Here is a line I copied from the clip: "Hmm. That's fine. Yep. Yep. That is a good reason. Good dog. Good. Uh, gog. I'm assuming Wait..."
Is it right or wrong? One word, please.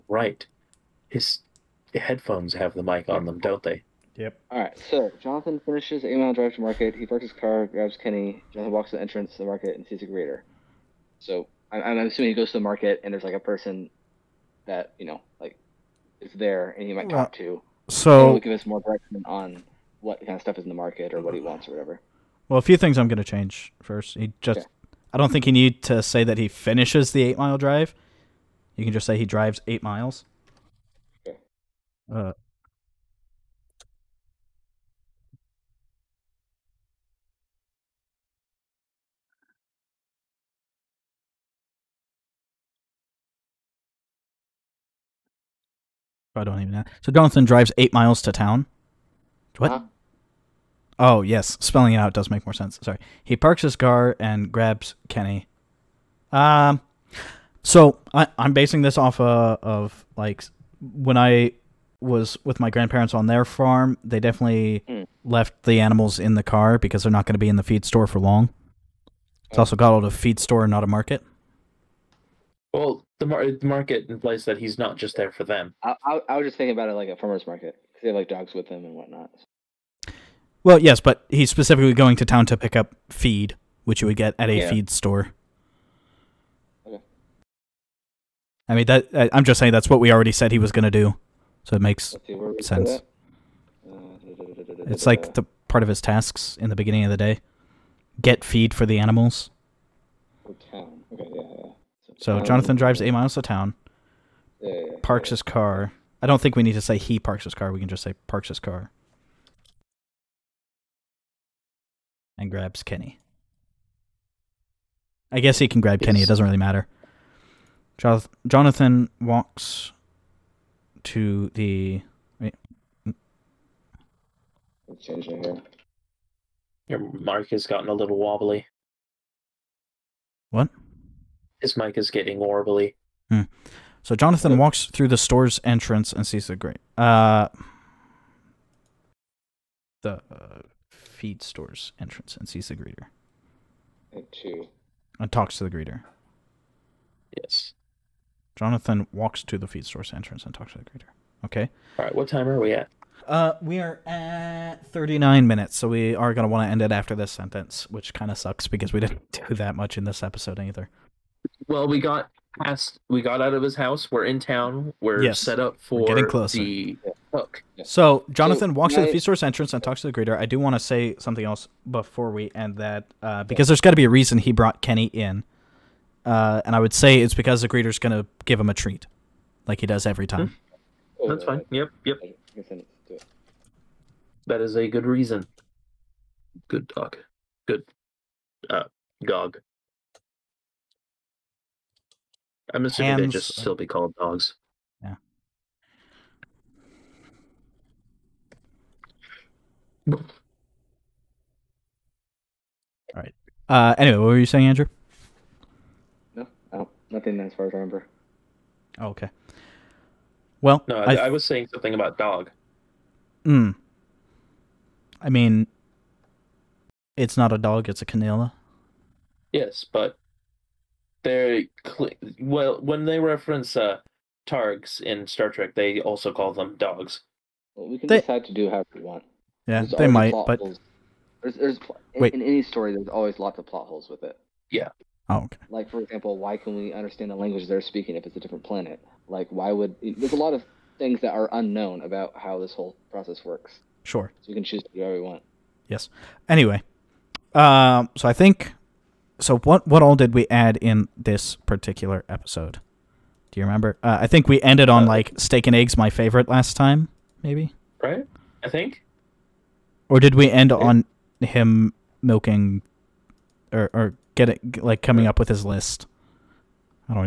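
wrong.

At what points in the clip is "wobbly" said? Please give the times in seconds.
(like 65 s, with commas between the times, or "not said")
128 s, 132 s.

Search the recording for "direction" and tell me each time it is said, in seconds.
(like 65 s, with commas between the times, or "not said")
18 s.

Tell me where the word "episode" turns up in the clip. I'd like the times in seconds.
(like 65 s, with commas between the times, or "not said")
160 s, 252 s.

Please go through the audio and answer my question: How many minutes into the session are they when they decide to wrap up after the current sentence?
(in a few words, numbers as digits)
39.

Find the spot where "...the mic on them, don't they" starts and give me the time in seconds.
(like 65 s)
2 s.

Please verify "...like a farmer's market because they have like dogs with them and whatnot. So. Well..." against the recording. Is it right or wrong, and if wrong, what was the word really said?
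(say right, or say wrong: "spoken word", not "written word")
right.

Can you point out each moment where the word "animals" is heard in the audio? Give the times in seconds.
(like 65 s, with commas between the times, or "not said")
65 s, 98 s.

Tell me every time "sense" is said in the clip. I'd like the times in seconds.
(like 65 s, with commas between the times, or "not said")
52 s, 92 s.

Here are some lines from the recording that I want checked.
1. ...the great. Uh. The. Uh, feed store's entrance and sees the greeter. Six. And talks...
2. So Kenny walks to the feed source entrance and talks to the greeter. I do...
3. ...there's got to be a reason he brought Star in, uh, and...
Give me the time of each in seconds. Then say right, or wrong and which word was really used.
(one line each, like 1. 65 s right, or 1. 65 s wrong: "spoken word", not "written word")
1. 136 s wrong: "Two", not "Six"
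2. 167 s wrong: "Jonathan", not "Kenny"
3. 173 s wrong: "Kenny", not "Star".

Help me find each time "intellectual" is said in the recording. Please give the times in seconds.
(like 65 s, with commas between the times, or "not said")
not said.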